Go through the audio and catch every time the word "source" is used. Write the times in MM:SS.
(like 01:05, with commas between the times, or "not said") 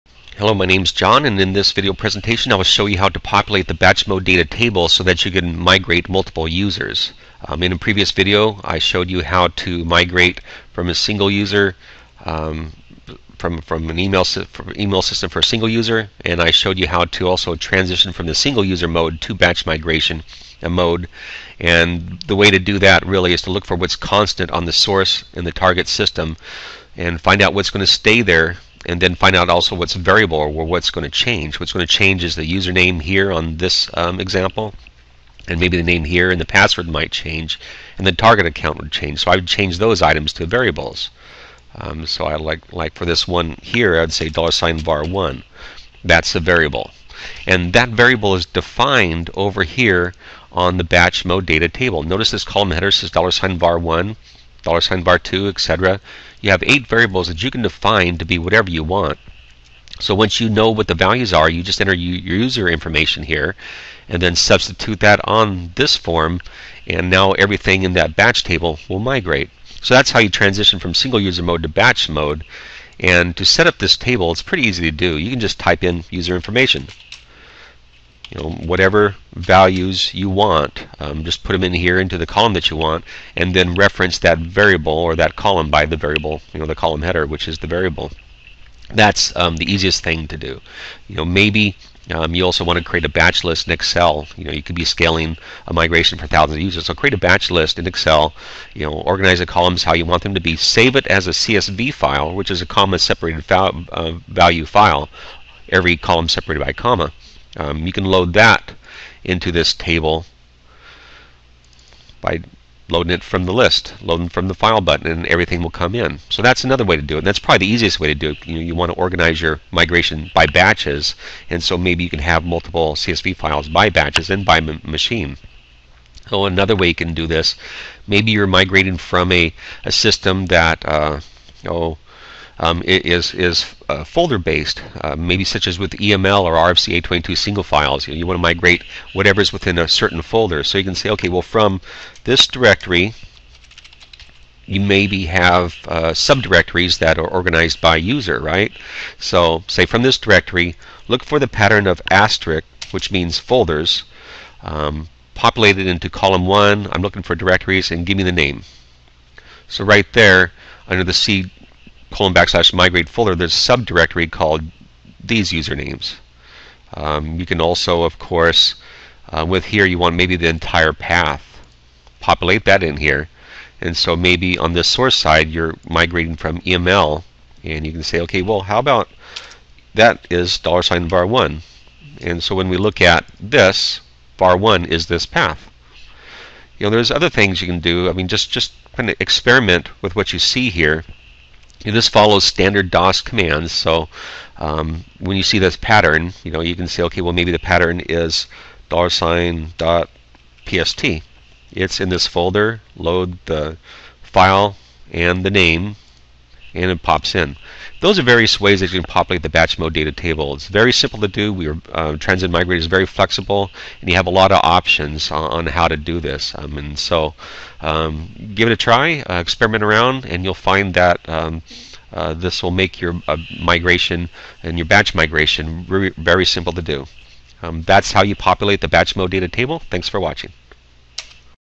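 00:24, 02:54.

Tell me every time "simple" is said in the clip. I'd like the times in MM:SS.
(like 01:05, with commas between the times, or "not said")
03:30, 03:46.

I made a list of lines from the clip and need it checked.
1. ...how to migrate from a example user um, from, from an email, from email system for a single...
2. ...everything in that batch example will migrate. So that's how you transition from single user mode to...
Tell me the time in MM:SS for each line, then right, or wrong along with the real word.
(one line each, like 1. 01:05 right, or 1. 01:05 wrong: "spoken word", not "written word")
1. 00:09 wrong: "single", not "example"
2. 01:07 wrong: "table", not "example".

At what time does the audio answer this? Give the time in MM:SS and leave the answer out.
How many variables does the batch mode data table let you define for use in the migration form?
00:56.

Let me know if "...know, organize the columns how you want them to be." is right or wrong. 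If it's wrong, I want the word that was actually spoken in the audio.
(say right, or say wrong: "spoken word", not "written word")
right.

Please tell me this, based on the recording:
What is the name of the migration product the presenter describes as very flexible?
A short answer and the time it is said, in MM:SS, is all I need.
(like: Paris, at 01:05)
Transend Migrator, at 03:32.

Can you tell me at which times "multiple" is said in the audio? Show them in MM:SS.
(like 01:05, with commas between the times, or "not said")
00:06, 02:02.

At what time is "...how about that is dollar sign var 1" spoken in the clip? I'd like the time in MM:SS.
02:58.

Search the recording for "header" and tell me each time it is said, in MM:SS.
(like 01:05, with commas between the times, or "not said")
00:52, 01:27.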